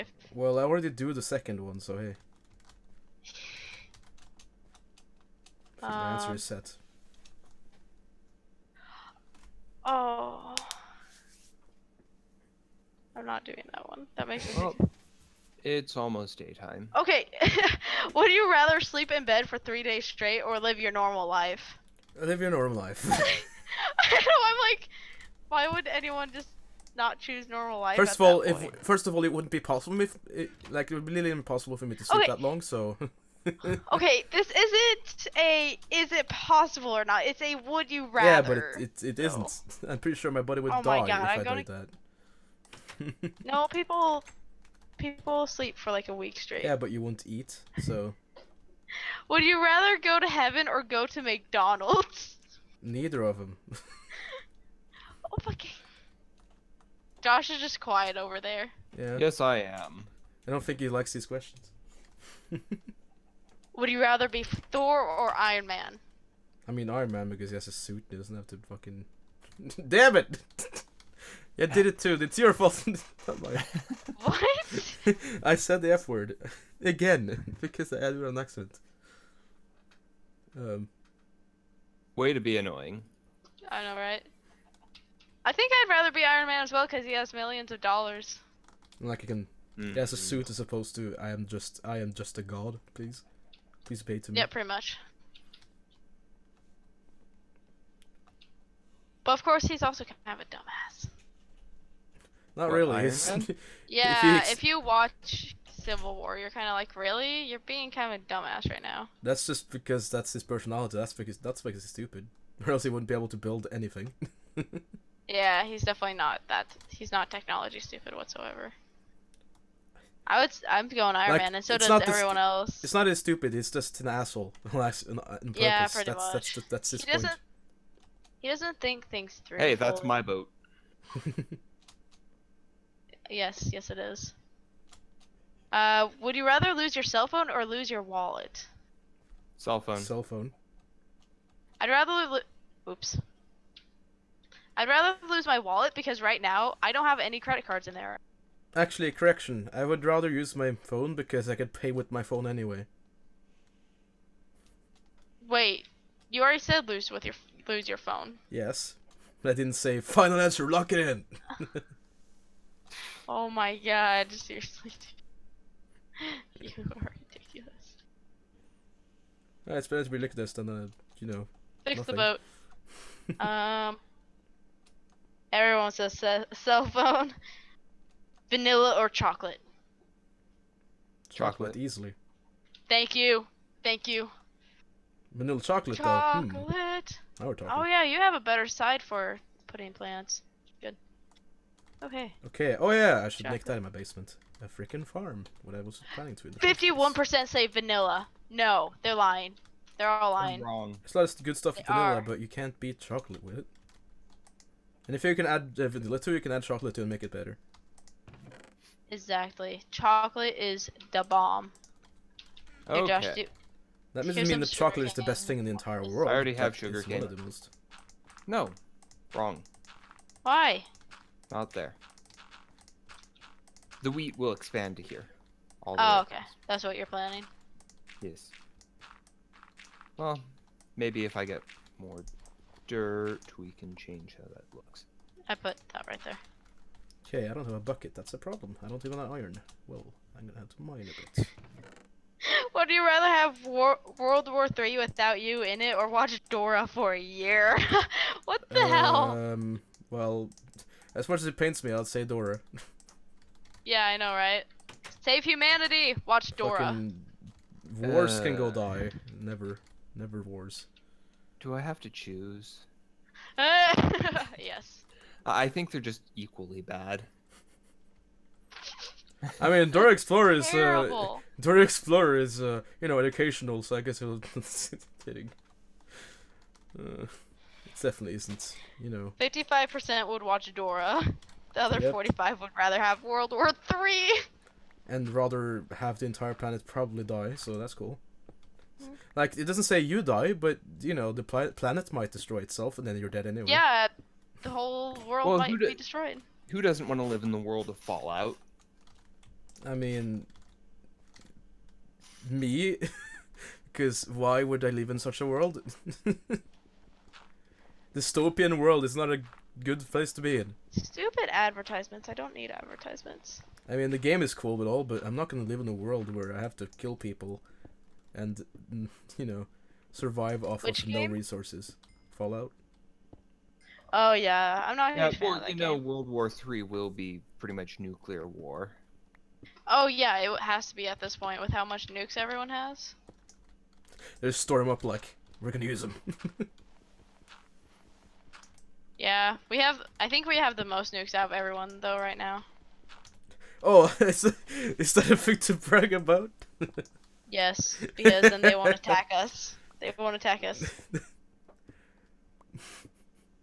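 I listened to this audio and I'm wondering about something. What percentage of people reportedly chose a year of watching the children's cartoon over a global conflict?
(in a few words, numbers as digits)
55%.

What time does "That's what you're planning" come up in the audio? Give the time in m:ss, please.
3:46.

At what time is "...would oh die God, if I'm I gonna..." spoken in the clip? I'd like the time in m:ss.
0:40.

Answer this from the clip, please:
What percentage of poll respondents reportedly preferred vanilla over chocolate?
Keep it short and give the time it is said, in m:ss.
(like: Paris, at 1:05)
51%, at 3:16.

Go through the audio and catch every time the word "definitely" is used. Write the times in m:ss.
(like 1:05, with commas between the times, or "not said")
1:55, 4:38.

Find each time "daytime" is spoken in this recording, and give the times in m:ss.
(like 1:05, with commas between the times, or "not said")
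0:16.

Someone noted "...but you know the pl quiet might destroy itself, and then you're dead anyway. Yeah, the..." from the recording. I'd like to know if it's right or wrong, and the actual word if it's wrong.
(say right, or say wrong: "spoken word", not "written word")
wrong: "planet", not "quiet".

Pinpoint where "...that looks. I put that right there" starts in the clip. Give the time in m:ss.
3:54.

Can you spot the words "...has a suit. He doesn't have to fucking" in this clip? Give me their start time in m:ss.
1:07.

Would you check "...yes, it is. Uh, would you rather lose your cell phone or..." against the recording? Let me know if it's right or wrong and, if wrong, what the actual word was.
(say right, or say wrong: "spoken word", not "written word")
right.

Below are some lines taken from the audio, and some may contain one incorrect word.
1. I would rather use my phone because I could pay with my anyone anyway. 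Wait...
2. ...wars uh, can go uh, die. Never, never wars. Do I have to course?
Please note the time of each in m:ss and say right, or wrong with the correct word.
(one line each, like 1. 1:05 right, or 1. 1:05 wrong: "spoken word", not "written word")
1. 2:29 wrong: "phone", not "anyone"
2. 4:18 wrong: "choose", not "course".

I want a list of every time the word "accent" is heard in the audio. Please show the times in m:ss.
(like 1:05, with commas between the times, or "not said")
1:18.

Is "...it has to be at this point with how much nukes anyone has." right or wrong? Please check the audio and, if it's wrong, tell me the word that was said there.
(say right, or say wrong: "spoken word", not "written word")
wrong: "everyone", not "anyone".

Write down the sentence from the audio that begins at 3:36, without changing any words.
I already have that sugar cane.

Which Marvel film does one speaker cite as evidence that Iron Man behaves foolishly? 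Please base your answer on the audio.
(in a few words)
Civil War.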